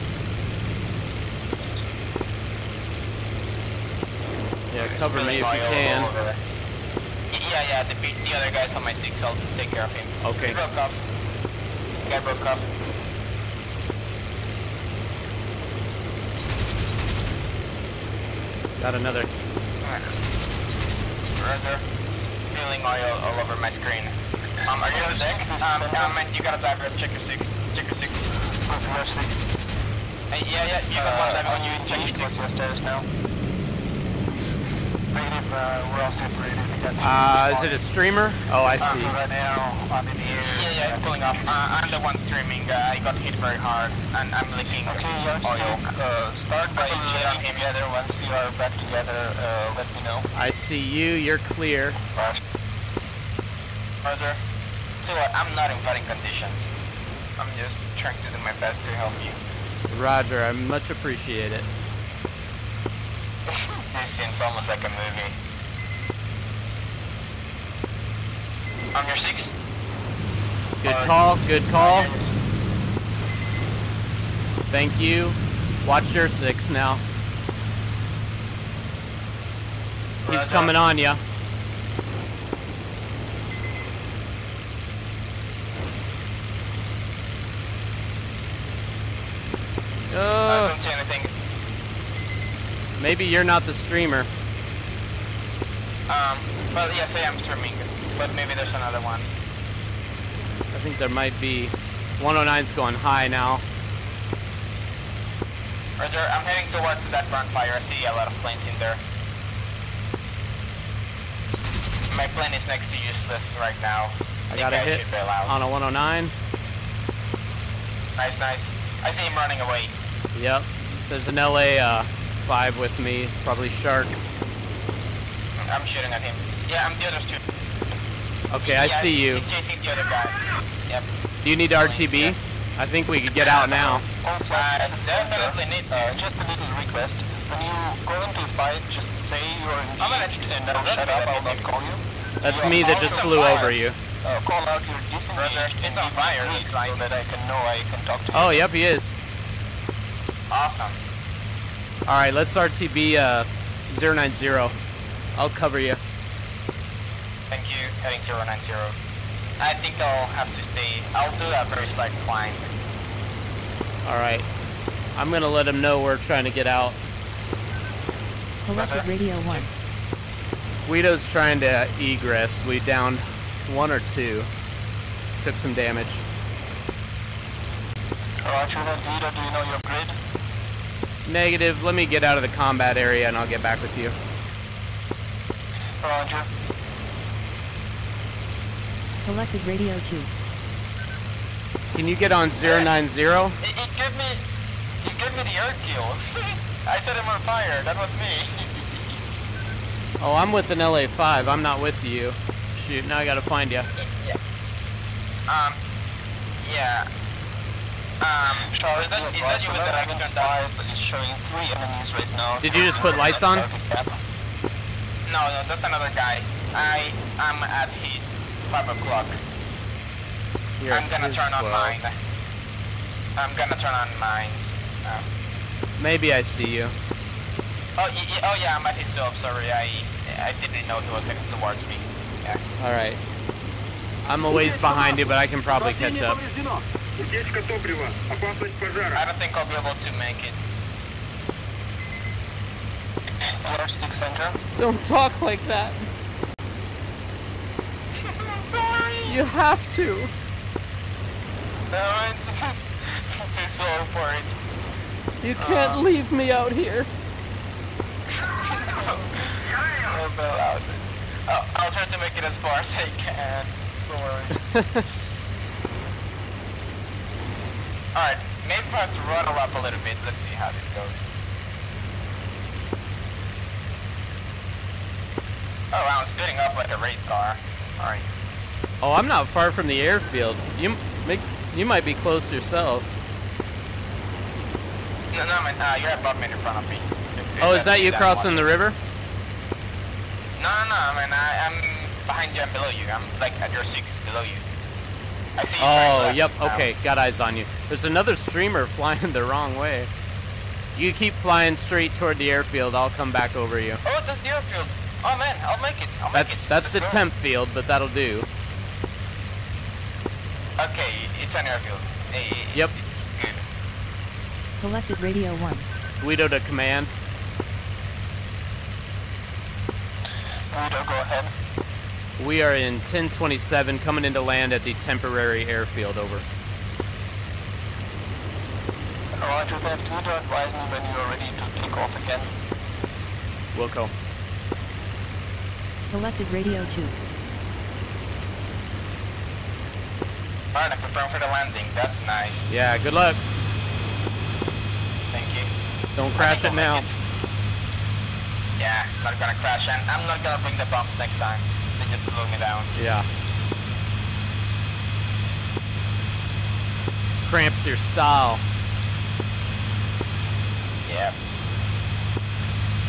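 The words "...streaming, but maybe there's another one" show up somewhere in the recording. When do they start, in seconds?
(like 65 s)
97 s.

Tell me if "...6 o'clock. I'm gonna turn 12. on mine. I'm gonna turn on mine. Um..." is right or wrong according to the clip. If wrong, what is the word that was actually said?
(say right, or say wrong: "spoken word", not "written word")
wrong: "5", not "6".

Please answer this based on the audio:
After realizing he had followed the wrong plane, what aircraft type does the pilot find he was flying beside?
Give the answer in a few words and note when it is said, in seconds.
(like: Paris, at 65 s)
LA5, at 200 s.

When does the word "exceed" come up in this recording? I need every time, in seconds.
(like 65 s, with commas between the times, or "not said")
not said.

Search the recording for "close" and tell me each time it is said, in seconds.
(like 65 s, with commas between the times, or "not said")
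282 s.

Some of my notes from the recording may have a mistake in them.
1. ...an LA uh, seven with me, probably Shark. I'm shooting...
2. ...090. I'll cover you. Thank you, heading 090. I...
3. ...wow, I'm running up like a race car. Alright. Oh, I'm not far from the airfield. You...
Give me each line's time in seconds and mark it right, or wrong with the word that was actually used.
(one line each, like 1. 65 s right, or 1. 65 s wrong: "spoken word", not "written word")
1. 121 s wrong: "five", not "seven"
2. 154 s right
3. 275 s wrong: "spinning", not "running".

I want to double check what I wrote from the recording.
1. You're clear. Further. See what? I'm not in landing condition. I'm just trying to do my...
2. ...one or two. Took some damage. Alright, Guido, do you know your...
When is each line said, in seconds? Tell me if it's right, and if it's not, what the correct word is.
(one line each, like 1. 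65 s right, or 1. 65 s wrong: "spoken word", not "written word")
1. 51 s wrong: "fighting", not "landing"
2. 173 s right.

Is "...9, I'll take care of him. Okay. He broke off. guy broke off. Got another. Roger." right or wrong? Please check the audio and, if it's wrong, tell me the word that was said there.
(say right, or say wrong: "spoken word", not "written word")
wrong: "6", not "9".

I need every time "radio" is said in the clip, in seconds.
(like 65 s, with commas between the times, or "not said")
169 s, 189 s, 315 s, 336 s.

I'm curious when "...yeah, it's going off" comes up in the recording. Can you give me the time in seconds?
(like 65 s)
40 s.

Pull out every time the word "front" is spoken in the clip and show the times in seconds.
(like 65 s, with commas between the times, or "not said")
107 s, 286 s.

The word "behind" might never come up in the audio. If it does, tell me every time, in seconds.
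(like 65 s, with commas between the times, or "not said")
234 s, 292 s.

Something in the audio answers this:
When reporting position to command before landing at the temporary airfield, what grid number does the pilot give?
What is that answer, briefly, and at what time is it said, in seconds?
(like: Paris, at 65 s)
1027, at 322 s.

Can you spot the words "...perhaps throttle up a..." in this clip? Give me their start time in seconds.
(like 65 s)
268 s.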